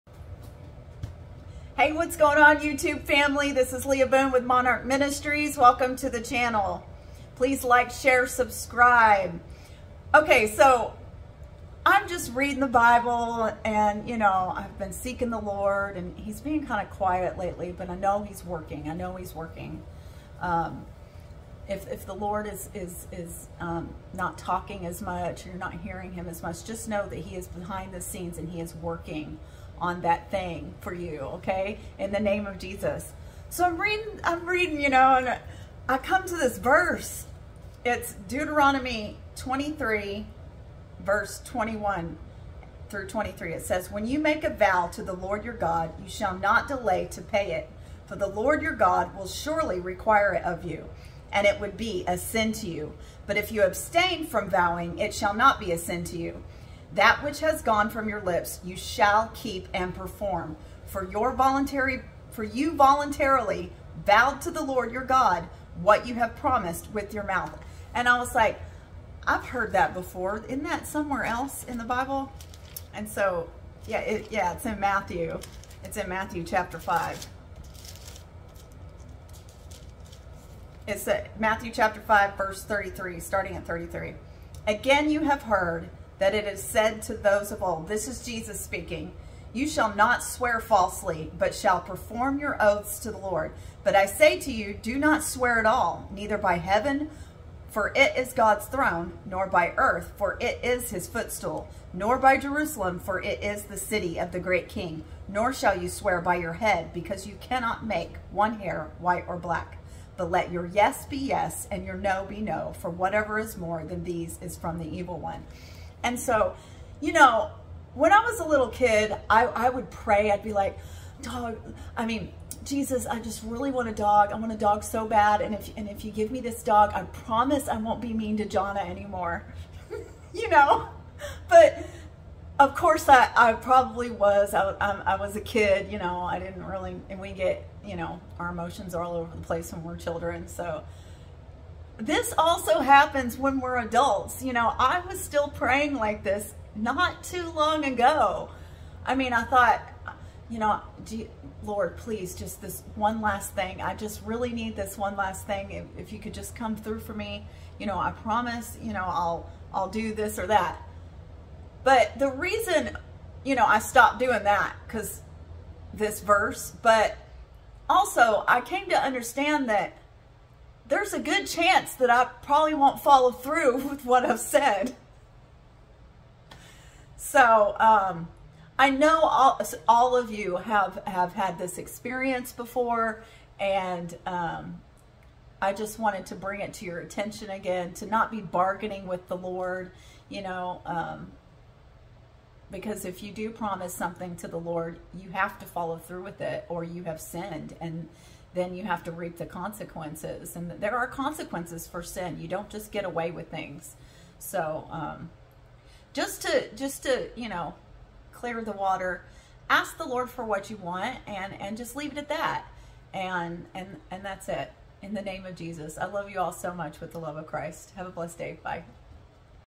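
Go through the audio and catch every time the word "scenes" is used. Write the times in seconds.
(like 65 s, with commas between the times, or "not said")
28 s.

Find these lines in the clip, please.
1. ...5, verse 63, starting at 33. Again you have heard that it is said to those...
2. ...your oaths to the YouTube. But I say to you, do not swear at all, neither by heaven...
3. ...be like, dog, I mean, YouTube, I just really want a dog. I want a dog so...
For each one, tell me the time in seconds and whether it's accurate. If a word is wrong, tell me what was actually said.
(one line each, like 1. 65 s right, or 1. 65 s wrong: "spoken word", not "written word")
1. 82 s wrong: "33", not "63"
2. 92 s wrong: "Lord", not "YouTube"
3. 120 s wrong: "Jesus", not "YouTube".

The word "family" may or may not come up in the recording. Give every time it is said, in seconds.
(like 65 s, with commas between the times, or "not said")
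3 s.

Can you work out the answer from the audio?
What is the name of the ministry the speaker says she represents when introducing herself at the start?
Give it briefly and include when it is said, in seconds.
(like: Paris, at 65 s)
Monarch Ministries, at 4 s.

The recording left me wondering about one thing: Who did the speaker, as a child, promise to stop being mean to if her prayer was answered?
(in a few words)
Jonna.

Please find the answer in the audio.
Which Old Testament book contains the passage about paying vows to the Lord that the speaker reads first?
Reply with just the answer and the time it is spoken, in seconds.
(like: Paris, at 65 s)
Deuteronomy, at 38 s.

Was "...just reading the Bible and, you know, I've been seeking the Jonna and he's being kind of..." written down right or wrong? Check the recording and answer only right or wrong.
wrong.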